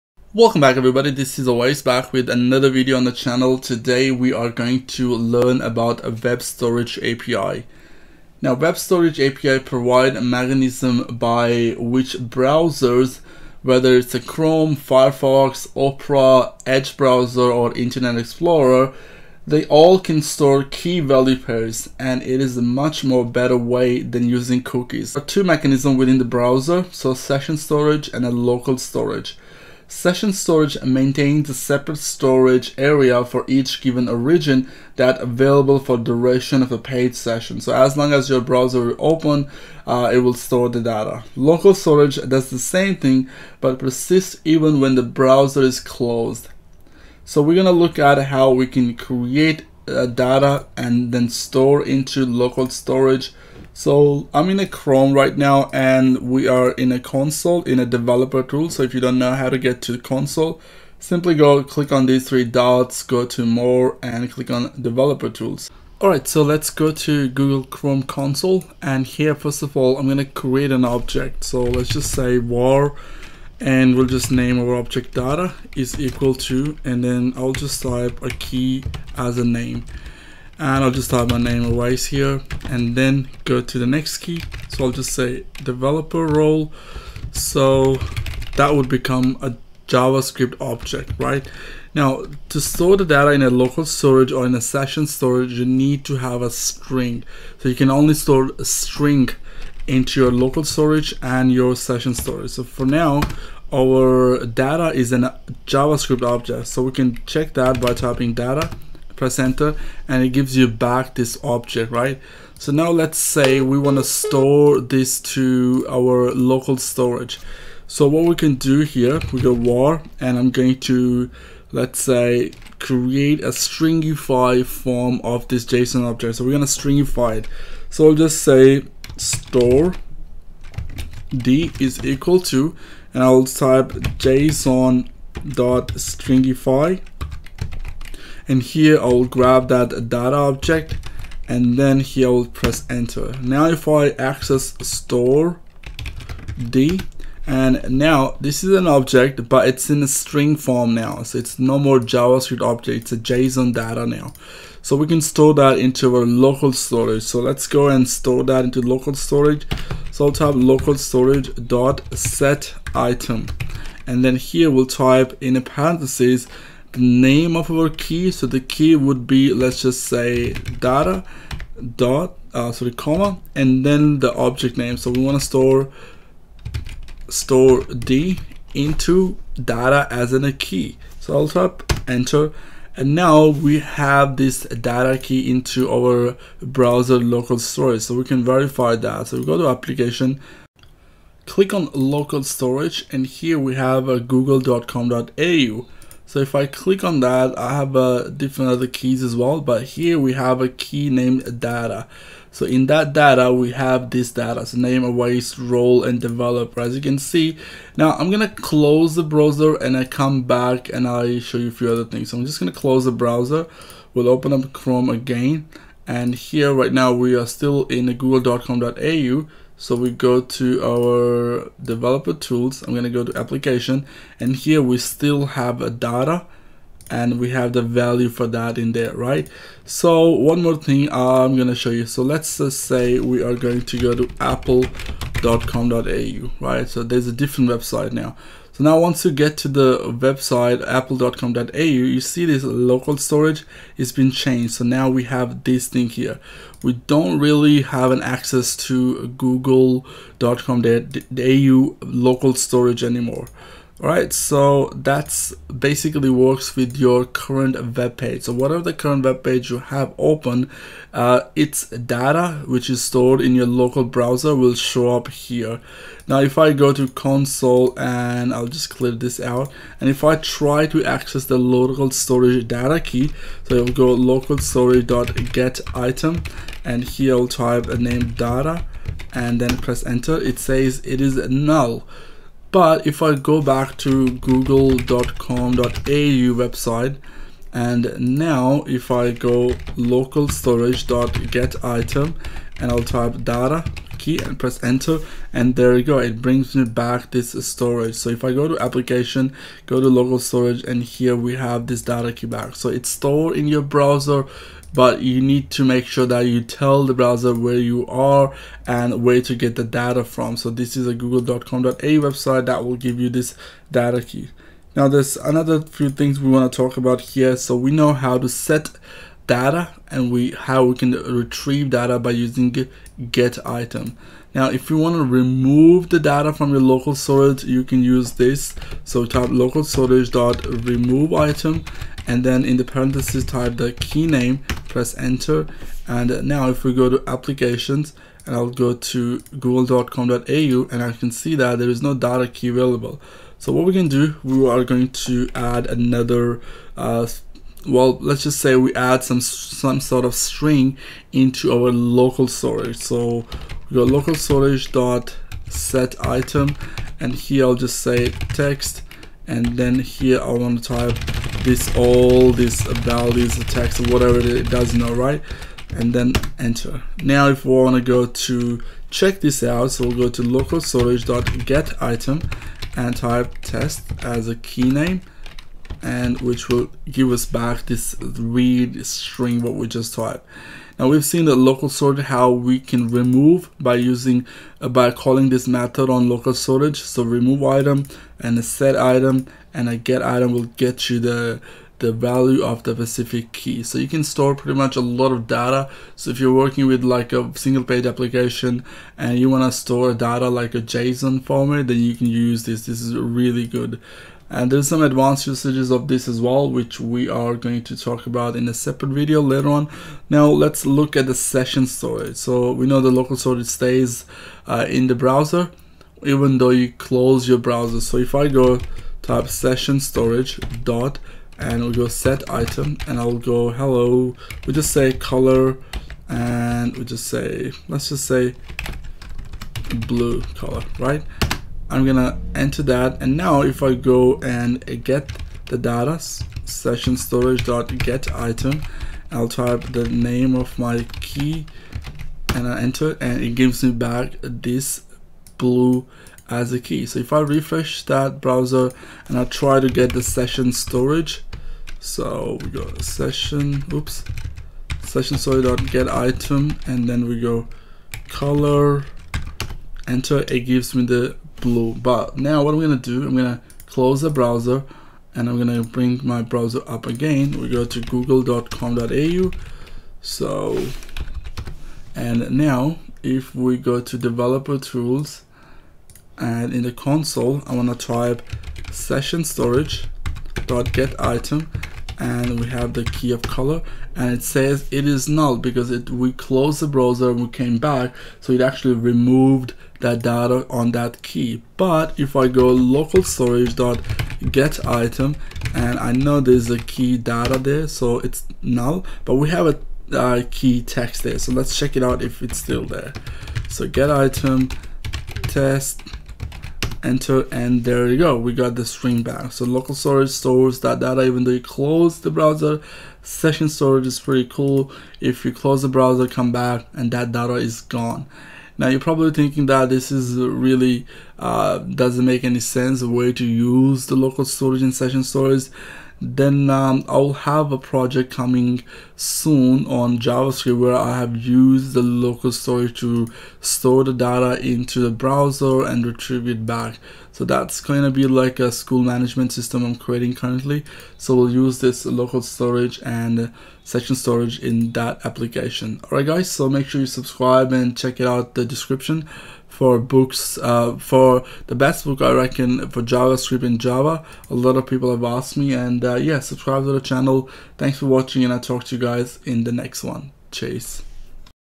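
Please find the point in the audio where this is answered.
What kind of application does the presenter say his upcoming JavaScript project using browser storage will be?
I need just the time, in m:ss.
8:58.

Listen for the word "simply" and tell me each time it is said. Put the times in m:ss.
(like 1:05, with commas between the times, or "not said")
1:00.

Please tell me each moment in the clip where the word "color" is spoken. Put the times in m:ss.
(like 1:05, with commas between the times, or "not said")
7:05, 7:10, 7:38, 8:03.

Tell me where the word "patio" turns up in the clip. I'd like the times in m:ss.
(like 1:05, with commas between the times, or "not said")
not said.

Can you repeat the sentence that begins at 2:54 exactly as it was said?
So we want to store store D into data as in a key.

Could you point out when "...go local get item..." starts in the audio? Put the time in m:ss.
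4:33.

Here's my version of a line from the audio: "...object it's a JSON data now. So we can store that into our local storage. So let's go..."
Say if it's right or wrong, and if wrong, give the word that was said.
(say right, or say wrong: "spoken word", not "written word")
right.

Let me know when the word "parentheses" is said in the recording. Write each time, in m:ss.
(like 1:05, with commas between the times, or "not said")
2:45, 5:32.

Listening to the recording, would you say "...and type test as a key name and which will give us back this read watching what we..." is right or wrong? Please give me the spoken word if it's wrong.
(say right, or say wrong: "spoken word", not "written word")
wrong: "string", not "watching".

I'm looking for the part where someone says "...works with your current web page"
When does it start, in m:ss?
4:16.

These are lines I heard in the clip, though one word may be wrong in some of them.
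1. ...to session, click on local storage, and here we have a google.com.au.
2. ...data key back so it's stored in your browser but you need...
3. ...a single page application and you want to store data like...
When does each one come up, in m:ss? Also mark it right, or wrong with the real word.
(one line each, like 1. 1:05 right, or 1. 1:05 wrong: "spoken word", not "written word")
1. 3:09 wrong: "application", not "session"
2. 5:02 right
3. 6:37 right.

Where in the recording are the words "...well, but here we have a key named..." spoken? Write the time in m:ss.
3:19.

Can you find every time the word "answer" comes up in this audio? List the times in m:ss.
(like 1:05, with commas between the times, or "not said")
not said.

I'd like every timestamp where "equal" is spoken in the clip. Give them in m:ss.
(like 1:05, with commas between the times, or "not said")
1:15, 2:12.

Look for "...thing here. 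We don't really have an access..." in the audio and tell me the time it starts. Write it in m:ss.
4:05.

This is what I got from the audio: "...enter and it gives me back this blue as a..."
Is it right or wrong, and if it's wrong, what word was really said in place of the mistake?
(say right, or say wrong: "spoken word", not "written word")
right.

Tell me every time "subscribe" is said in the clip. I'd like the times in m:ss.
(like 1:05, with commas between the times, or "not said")
9:07, 9:16.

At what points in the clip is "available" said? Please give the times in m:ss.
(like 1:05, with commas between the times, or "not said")
0:35, 5:42.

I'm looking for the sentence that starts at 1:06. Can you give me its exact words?
Alright, so let's go to Google Chrome console and here first of all I'm going to create an object.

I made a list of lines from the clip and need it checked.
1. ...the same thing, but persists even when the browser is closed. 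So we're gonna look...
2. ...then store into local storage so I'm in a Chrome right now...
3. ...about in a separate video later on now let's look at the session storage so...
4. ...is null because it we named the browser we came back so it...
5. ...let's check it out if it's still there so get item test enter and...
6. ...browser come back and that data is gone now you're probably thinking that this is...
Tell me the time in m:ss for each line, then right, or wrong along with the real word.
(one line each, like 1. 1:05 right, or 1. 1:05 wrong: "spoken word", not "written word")
1. 0:42 right
2. 0:51 right
3. 6:48 right
4. 8:05 wrong: "closed", not "named"
5. 8:21 right
6. 8:35 right.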